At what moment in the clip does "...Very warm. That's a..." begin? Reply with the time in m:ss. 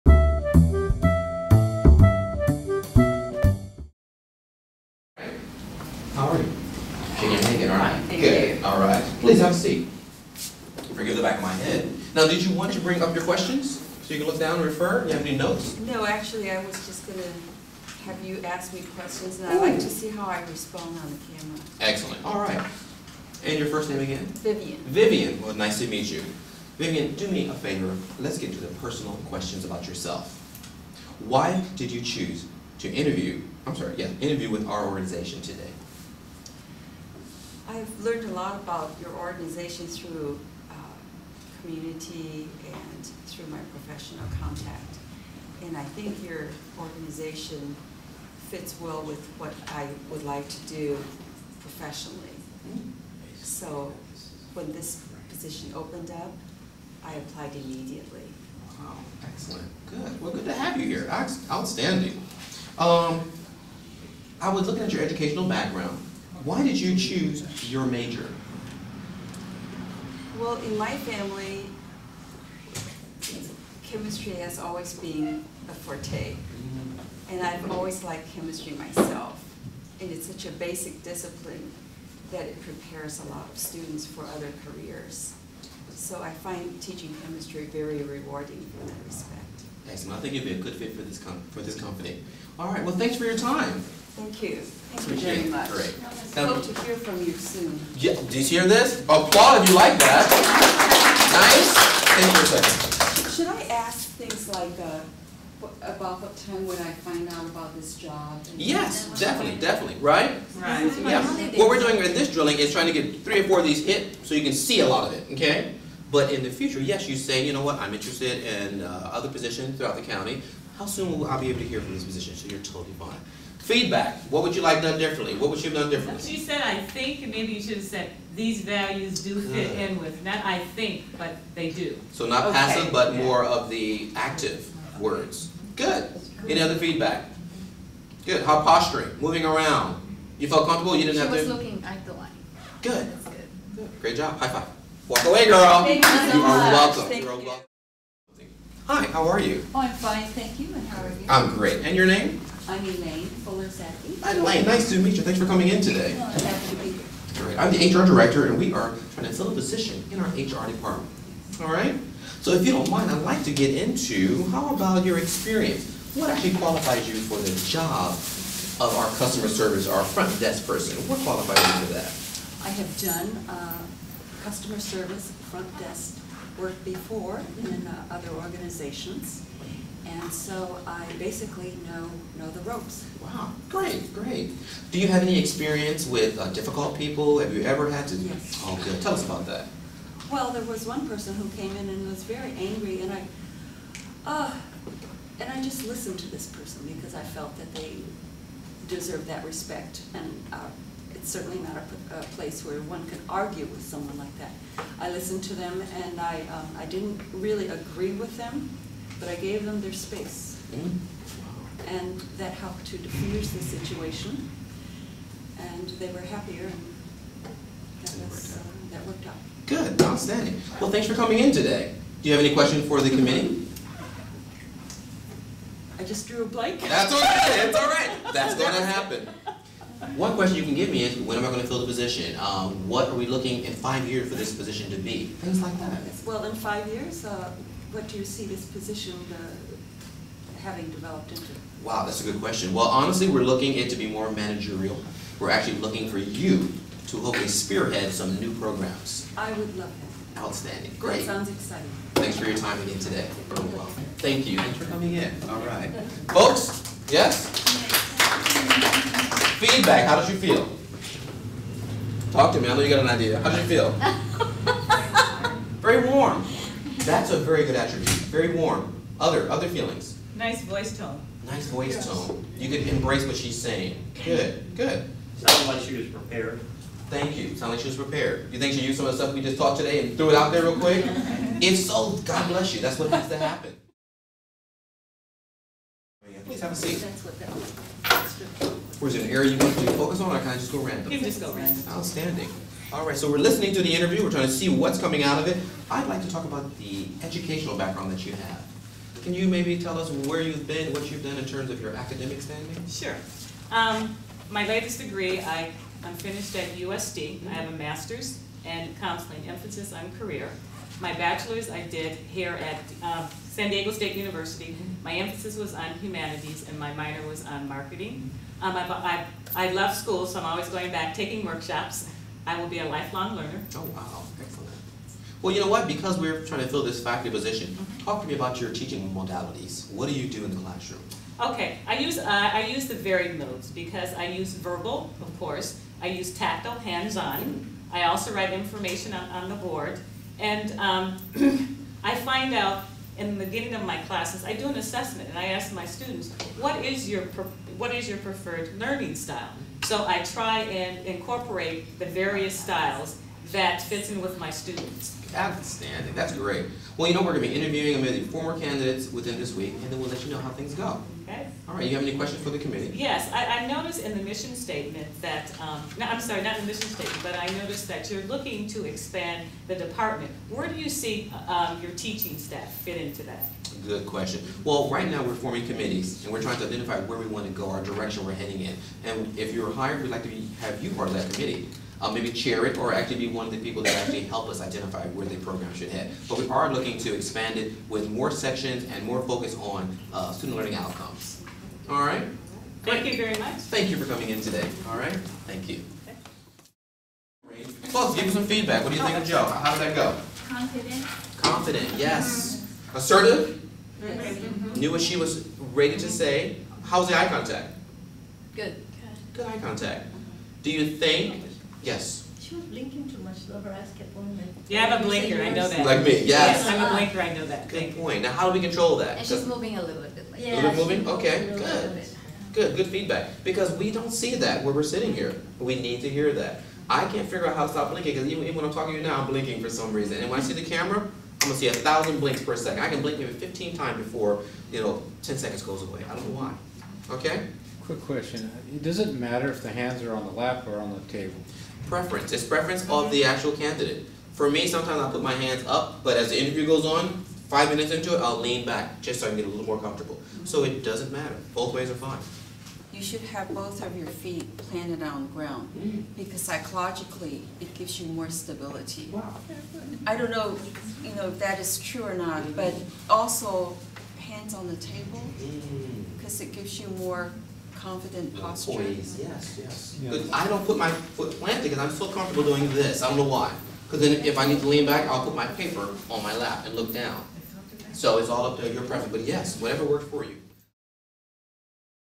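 4:25.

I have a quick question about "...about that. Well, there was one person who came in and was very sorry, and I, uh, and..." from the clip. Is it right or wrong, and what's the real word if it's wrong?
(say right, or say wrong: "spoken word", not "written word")
wrong: "angry", not "sorry".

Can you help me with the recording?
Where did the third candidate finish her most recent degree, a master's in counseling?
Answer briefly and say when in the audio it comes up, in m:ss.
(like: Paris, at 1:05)
USD, at 5:06.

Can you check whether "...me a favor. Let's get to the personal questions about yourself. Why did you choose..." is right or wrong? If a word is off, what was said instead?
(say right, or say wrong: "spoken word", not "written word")
right.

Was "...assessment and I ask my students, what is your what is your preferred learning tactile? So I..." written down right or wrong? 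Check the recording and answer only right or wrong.
wrong.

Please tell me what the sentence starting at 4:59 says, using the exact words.
Can you maybe tell us where you've been, what you've done in terms of your academic standing?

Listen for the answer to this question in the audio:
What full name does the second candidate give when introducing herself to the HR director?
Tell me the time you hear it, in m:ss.
2:32.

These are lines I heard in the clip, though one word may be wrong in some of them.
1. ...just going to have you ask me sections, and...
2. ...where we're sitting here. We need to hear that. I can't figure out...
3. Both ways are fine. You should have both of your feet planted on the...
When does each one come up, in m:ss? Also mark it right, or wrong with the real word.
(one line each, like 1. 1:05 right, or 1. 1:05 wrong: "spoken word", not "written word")
1. 0:16 wrong: "questions", not "sections"
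2. 7:04 right
3. 7:31 right.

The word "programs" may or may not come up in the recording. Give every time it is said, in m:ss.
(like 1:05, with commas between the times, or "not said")
4:08, 6:25.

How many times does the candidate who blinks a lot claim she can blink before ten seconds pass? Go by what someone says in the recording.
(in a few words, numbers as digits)
15.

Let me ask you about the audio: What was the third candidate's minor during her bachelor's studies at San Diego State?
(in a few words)
Marketing.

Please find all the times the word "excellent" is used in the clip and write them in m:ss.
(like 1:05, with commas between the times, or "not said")
0:21, 0:59, 1:29, 5:24.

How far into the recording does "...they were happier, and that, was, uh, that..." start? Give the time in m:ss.
3:35.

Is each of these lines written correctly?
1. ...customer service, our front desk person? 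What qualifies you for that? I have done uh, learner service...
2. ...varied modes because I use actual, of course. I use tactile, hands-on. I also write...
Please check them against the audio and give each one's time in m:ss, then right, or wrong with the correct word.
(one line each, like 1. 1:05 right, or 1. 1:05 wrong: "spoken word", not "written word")
1. 2:49 wrong: "customer", not "learner"
2. 5:32 wrong: "verbal", not "actual".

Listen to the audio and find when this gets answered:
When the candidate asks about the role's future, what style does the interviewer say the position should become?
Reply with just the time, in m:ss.
4:04.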